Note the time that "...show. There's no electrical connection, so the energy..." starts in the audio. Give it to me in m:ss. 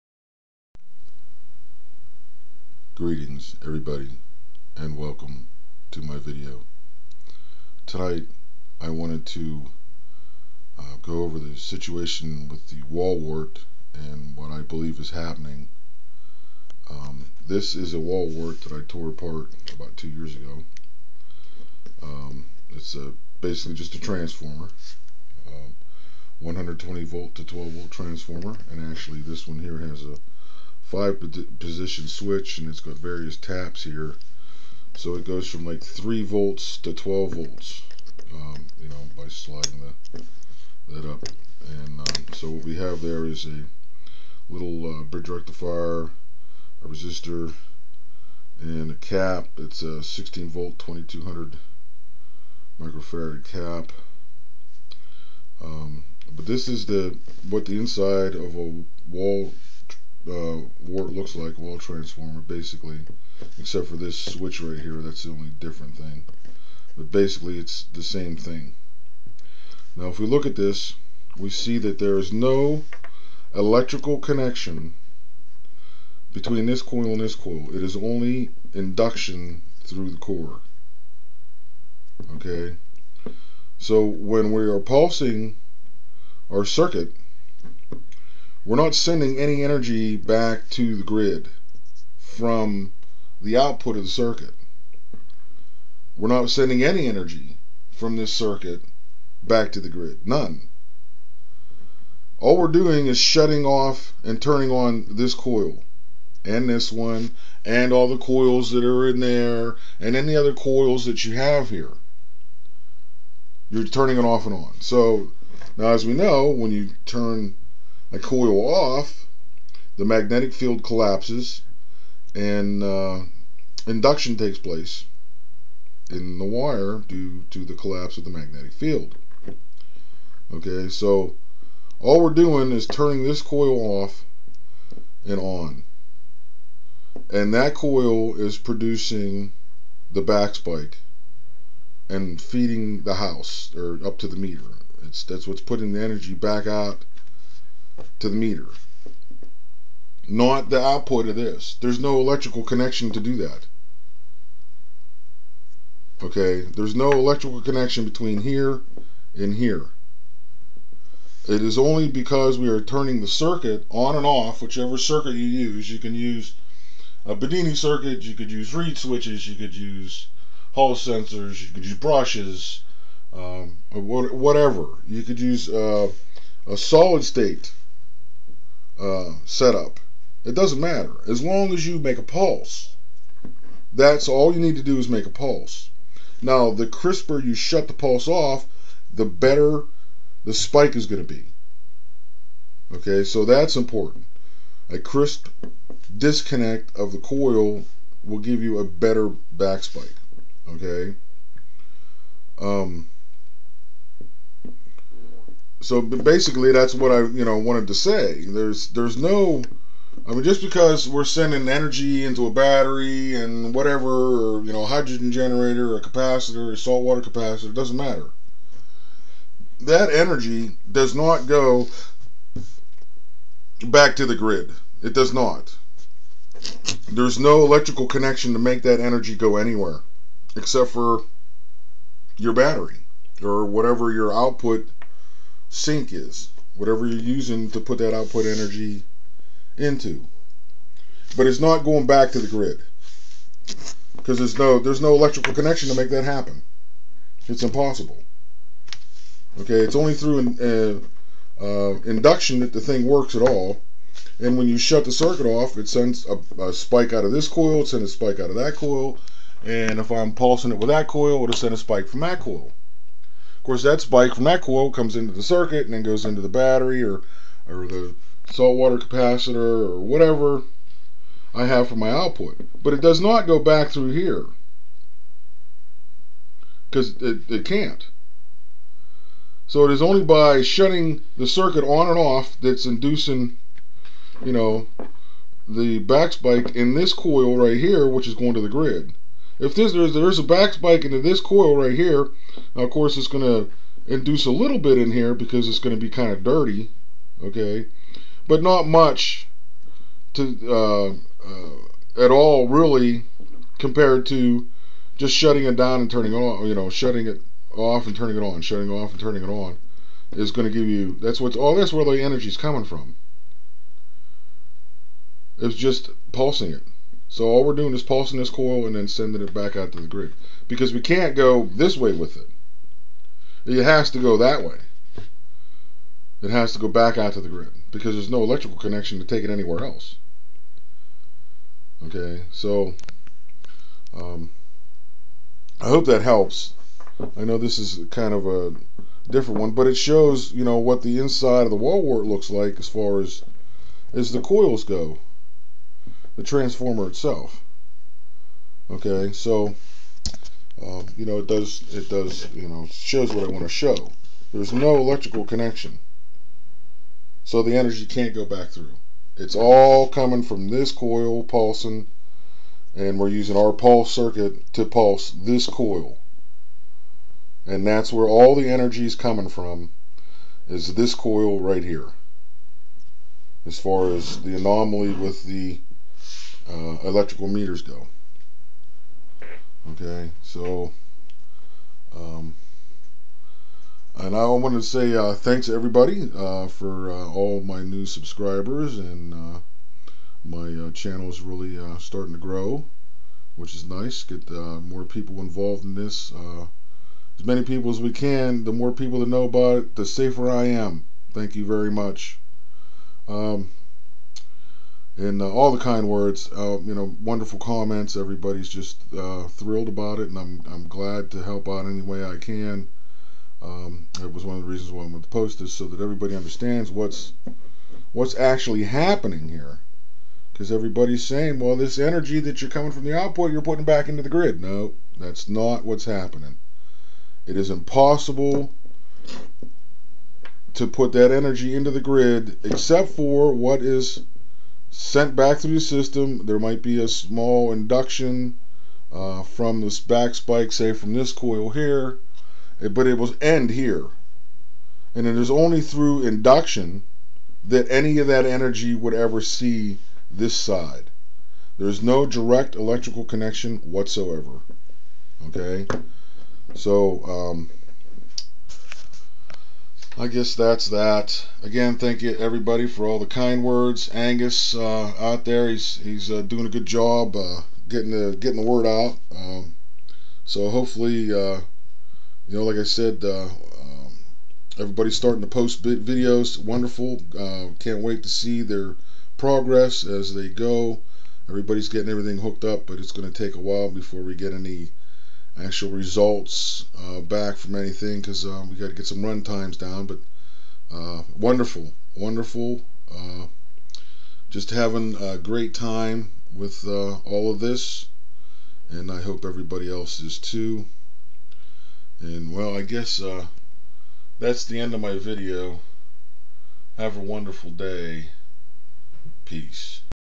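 5:53.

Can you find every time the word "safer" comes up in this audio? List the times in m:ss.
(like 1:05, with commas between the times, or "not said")
6:40.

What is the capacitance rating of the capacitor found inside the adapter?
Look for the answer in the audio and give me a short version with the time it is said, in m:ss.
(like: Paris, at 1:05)
2200 microfarad, at 0:50.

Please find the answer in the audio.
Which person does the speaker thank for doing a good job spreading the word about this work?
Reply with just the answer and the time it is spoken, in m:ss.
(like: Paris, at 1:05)
Angus, at 7:44.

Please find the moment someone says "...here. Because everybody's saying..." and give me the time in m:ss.
6:59.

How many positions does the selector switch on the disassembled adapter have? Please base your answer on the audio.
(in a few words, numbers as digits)
5.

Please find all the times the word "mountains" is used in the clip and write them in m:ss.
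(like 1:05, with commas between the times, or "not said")
not said.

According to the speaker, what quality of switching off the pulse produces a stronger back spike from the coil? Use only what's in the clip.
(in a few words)
crisp disconnect.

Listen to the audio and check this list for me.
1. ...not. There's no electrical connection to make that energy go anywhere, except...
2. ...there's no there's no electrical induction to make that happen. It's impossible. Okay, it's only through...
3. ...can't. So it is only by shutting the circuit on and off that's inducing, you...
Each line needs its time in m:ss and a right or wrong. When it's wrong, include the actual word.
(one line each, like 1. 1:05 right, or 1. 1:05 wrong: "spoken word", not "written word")
1. 3:45 right
2. 4:04 wrong: "connection", not "induction"
3. 4:37 right.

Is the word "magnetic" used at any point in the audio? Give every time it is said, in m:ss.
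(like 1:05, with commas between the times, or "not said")
2:00, 2:08.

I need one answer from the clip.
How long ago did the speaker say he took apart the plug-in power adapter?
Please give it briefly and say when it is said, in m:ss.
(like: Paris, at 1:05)
2 years, at 0:19.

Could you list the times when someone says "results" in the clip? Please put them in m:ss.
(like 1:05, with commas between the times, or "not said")
8:05.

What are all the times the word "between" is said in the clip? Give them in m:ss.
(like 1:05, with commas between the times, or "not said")
1:16, 2:38.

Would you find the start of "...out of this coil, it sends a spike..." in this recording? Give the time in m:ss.
4:17.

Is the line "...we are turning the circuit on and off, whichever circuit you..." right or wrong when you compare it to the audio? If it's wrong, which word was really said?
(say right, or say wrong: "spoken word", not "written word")
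right.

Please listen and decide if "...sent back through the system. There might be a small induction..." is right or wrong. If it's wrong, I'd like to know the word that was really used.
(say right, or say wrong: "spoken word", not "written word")
right.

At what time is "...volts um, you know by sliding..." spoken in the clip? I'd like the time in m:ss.
0:37.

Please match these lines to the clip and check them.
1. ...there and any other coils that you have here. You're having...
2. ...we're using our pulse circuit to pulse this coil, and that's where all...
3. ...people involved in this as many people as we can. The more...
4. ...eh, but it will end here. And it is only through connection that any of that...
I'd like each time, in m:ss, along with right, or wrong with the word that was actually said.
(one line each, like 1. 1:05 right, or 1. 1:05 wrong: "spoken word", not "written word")
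1. 1:49 wrong: "turning", not "having"
2. 6:03 right
3. 6:35 right
4. 7:22 wrong: "induction", not "connection".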